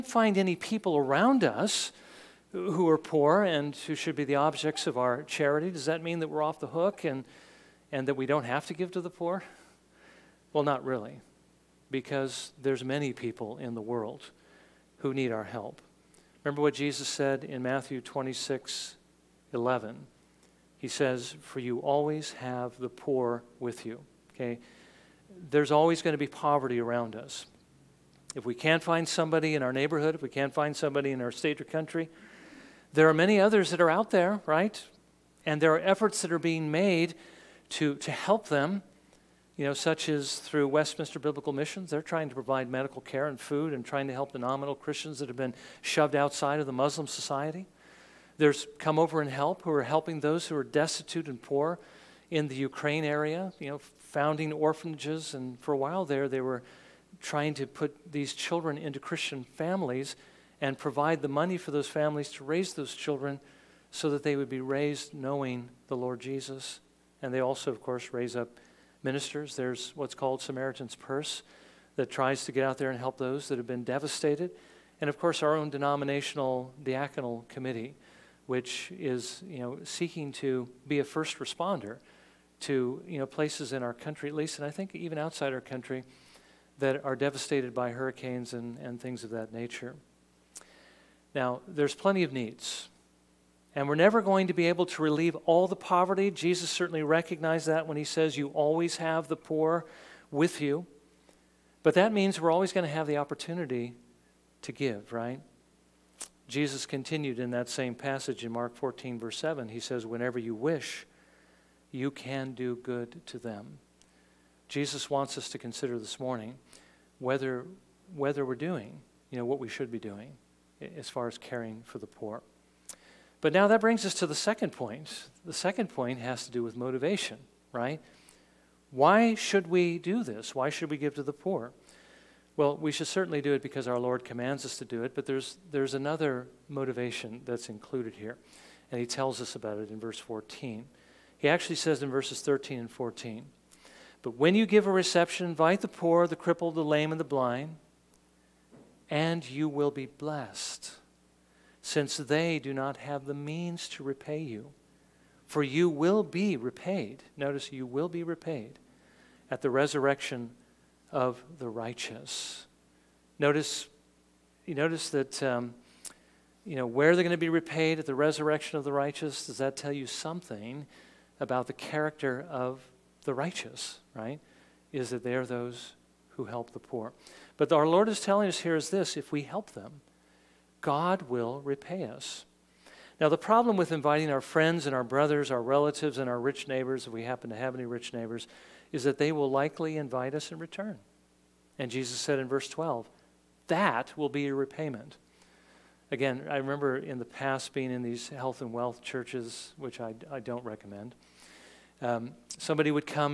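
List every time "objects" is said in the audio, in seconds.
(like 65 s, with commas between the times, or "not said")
4 s.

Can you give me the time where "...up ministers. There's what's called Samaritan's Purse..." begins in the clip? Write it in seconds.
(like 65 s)
68 s.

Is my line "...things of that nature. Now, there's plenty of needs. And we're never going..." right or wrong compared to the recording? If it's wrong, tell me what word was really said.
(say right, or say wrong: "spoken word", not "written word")
right.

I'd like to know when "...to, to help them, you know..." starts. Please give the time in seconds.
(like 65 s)
37 s.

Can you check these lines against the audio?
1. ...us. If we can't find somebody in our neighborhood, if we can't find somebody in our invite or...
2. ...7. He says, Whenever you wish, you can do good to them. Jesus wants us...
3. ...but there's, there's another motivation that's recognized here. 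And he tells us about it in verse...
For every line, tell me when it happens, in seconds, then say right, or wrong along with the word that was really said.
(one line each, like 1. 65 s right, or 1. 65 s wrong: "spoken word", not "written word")
1. 27 s wrong: "state", not "invite"
2. 109 s right
3. 135 s wrong: "included", not "recognized".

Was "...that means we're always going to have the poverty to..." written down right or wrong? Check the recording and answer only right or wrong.
wrong.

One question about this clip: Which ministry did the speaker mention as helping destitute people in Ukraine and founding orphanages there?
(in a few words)
Come Over and Help.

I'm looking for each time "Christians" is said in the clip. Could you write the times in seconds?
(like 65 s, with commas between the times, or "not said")
44 s, 59 s.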